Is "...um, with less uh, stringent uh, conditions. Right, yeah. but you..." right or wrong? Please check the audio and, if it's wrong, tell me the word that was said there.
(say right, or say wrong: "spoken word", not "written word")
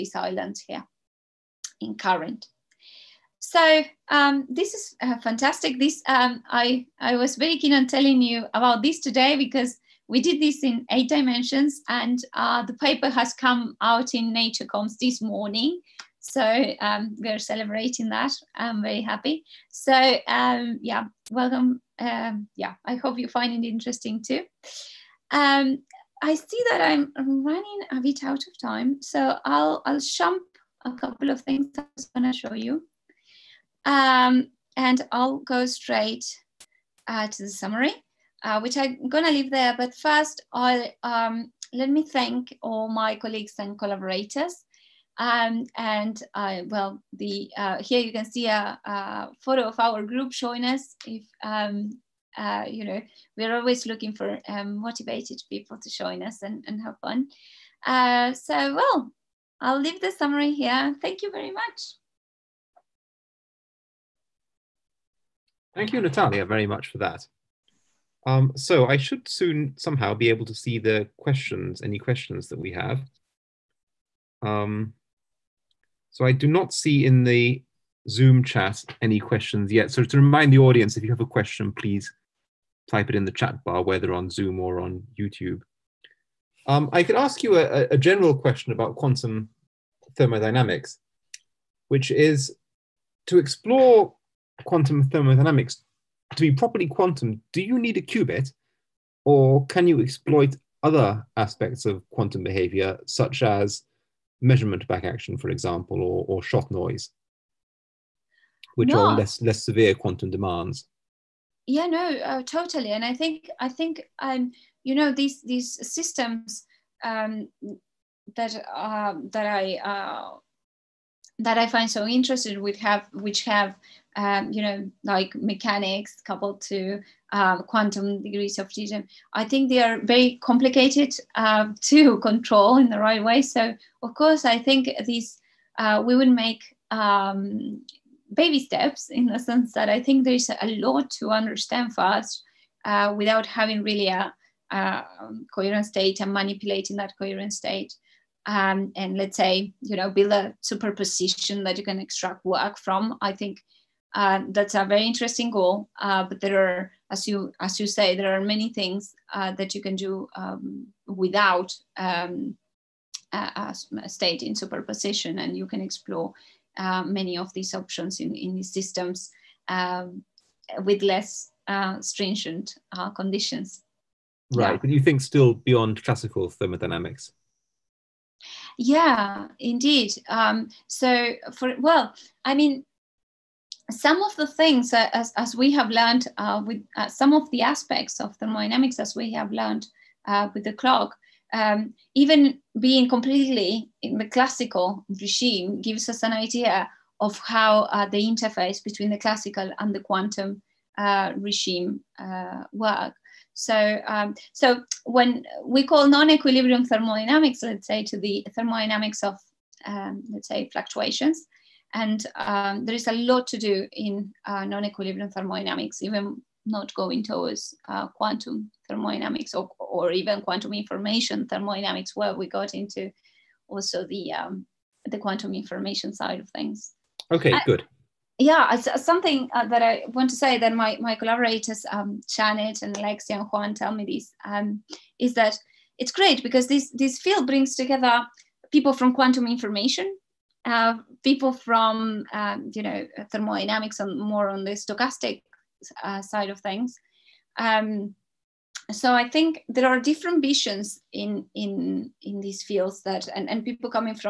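right.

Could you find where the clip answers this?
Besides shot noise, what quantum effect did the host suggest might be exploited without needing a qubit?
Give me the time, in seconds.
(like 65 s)
104 s.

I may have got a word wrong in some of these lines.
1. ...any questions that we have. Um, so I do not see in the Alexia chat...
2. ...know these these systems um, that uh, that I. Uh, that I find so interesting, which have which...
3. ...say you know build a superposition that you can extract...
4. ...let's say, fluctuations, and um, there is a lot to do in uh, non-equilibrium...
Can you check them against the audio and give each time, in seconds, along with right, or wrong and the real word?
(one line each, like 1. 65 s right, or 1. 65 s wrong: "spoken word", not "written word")
1. 71 s wrong: "Zoom", not "Alexia"
2. 114 s right
3. 149 s right
4. 210 s right.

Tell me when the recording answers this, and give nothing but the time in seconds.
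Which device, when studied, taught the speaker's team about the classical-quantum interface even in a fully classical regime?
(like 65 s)
190 s.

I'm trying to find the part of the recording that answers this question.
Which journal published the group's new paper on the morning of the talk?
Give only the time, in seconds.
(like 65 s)
14 s.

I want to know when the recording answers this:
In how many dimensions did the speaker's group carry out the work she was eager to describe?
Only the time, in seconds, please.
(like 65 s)
10 s.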